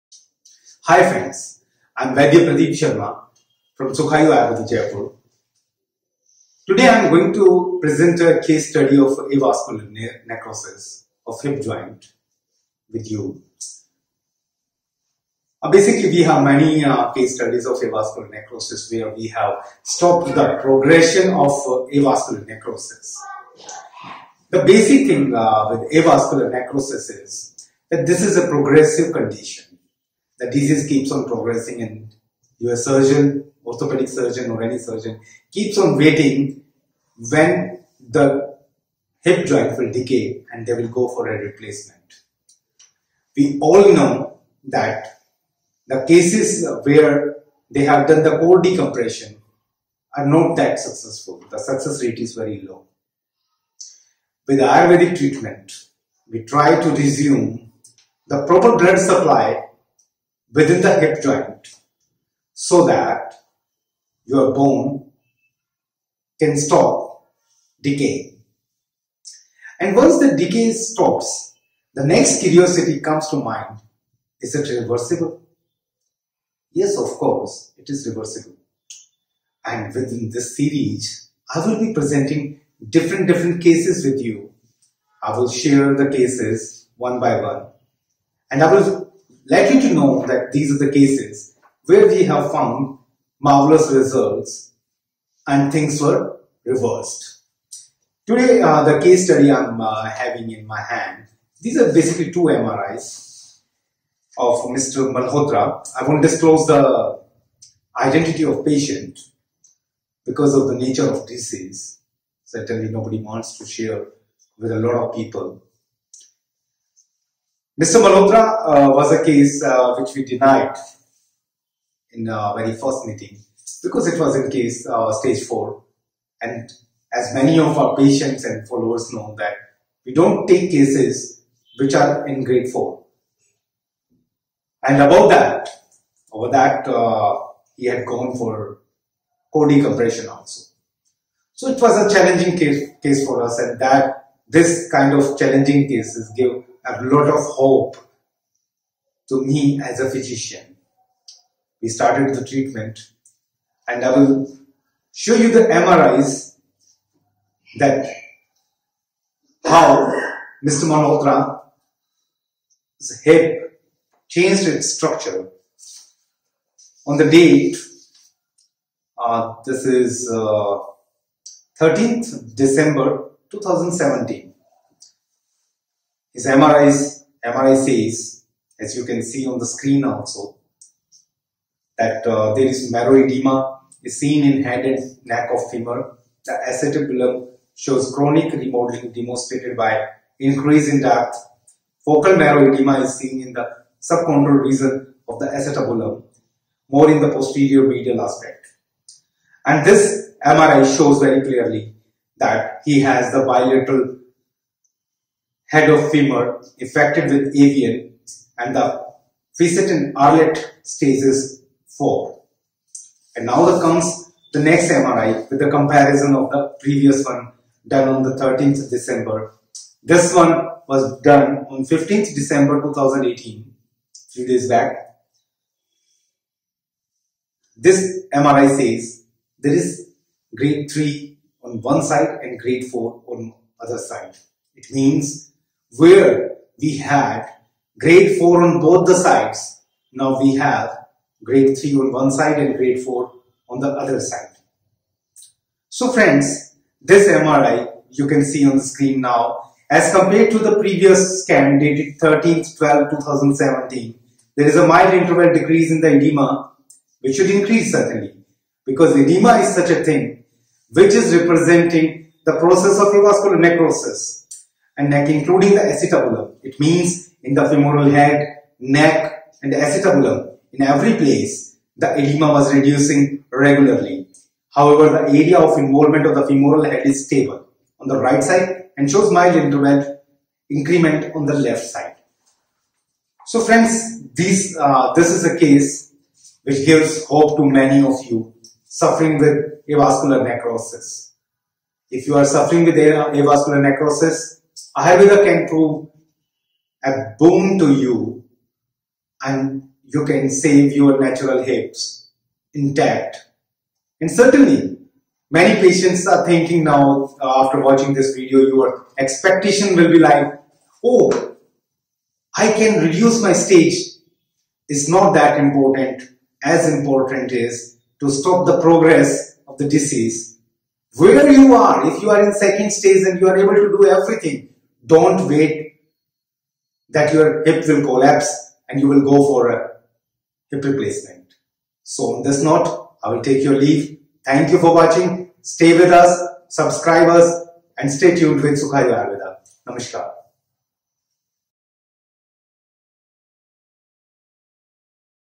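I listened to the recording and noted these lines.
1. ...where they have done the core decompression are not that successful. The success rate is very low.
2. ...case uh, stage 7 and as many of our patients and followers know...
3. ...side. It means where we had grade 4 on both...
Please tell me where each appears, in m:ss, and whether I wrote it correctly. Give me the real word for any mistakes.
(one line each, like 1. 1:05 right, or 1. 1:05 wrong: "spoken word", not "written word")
1. 0:46 right
2. 2:04 wrong: "4", not "7"
3. 3:53 right.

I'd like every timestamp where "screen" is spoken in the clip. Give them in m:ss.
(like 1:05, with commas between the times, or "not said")
2:59, 4:08.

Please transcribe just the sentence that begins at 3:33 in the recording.
And now there comes the next MRI with the comparison of the previous one done on the 13th December.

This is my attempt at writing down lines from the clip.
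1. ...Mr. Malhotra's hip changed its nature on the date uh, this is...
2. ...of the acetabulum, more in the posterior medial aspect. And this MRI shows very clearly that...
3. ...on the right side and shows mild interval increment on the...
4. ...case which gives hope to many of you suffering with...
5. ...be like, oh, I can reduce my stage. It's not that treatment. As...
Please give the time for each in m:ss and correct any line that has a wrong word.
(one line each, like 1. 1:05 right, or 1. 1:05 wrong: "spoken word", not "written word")
1. 2:40 wrong: "structure", not "nature"
2. 3:15 right
3. 4:37 right
4. 4:45 right
5. 5:10 wrong: "important", not "treatment".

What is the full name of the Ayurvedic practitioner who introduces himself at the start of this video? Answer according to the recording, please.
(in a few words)
Pradeep Sharma.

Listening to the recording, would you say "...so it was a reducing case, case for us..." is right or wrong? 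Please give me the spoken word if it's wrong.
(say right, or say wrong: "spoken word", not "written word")
wrong: "challenging", not "reducing".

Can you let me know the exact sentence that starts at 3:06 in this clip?
The acetabulum shows chronic remodeling demonstrated by increase in depth.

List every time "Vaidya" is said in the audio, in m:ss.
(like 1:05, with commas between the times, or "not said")
0:02.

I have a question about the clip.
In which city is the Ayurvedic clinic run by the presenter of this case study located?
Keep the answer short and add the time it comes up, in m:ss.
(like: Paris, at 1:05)
Jaipur, at 0:04.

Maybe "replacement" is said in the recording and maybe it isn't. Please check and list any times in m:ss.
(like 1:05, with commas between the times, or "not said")
0:41, 5:30.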